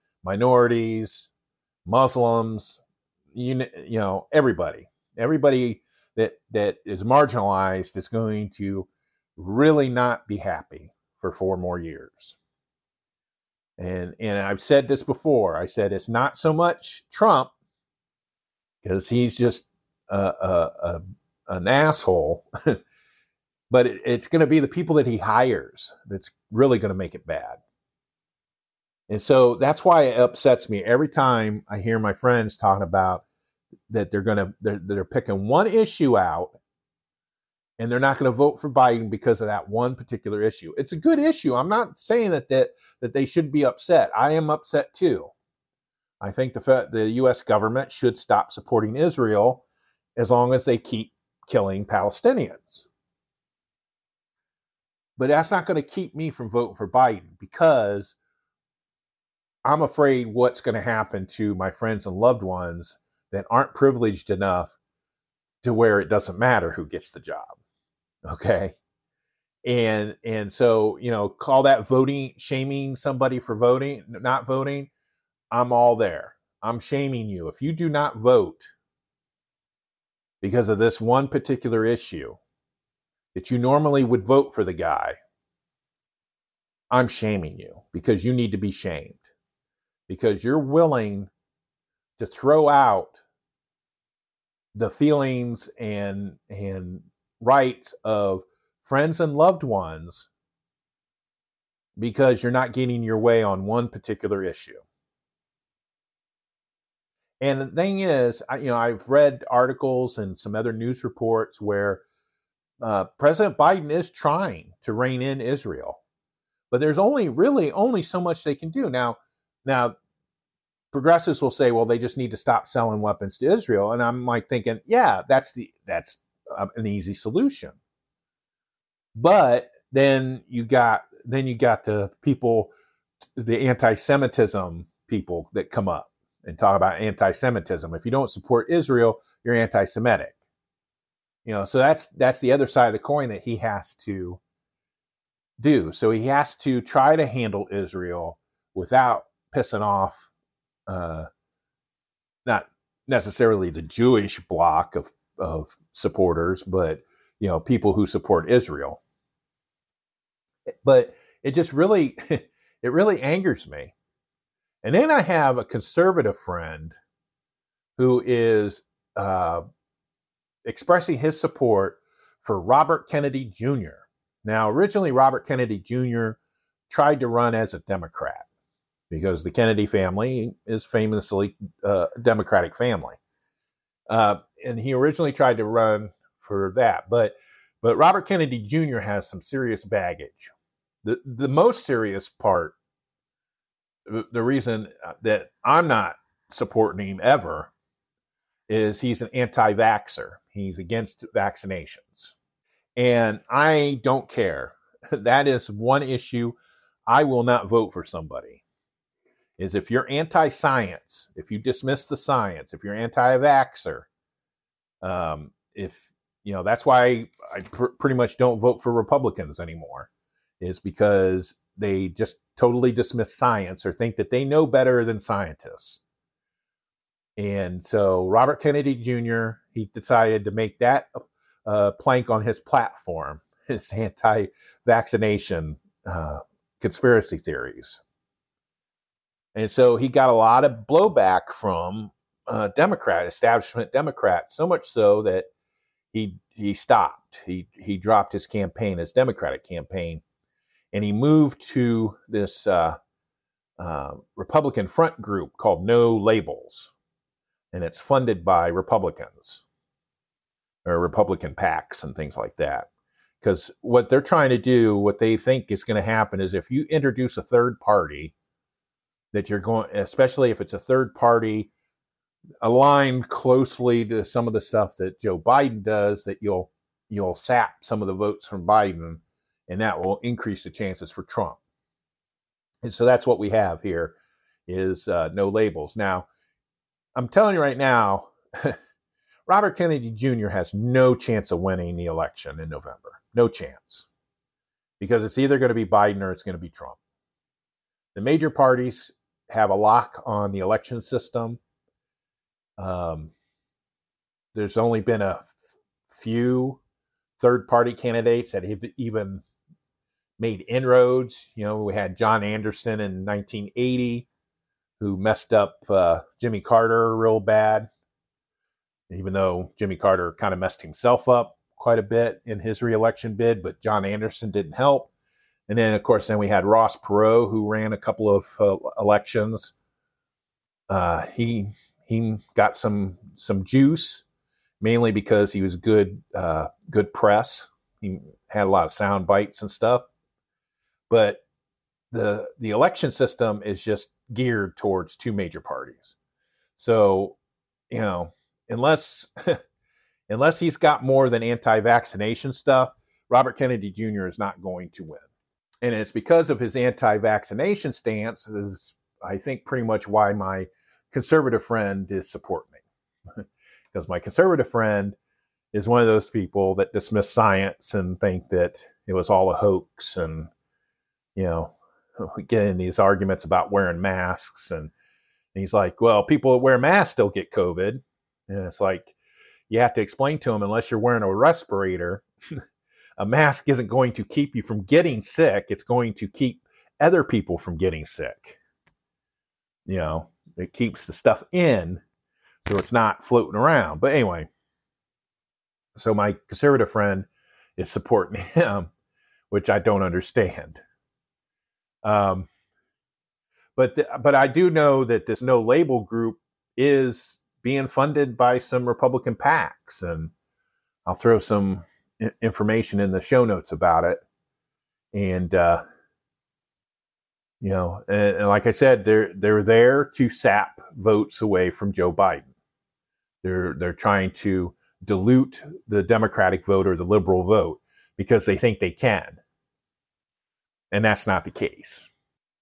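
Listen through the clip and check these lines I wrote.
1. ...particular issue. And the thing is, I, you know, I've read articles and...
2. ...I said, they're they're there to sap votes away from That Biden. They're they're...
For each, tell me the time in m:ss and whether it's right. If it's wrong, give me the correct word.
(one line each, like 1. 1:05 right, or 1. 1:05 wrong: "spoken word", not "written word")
1. 1:43 right
2. 6:58 wrong: "Joe", not "That".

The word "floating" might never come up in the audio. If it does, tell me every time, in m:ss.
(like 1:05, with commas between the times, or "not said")
6:33.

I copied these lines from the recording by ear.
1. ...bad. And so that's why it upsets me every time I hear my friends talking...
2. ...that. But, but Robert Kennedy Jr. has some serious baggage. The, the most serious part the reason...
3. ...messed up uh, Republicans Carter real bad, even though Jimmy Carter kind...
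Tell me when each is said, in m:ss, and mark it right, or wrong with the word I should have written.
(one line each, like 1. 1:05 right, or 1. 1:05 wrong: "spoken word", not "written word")
1. 0:27 right
2. 3:06 right
3. 5:15 wrong: "Jimmy", not "Republicans".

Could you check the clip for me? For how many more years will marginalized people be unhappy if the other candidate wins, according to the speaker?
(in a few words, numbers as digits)
4.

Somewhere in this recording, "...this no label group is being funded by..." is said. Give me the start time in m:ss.
6:45.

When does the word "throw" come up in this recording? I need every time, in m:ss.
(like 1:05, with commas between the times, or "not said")
1:32, 6:51.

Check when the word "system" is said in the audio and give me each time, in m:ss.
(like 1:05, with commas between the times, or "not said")
5:01, 5:43.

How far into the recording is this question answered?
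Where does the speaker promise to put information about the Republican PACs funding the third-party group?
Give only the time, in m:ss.
6:53.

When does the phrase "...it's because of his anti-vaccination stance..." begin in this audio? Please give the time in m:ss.
5:55.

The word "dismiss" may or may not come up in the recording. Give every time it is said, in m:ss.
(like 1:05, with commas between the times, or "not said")
3:31, 3:42, 6:06.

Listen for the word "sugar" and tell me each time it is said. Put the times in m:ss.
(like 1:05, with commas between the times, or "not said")
not said.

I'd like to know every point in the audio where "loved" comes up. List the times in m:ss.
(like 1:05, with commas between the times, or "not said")
1:02, 1:39.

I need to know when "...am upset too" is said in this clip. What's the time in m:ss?
0:44.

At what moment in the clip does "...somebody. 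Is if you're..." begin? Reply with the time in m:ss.
3:28.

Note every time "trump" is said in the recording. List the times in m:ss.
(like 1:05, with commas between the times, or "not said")
0:17, 4:41, 4:56.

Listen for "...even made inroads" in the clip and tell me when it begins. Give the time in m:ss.
5:08.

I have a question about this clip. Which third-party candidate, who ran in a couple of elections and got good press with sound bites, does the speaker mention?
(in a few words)
Ross Perot.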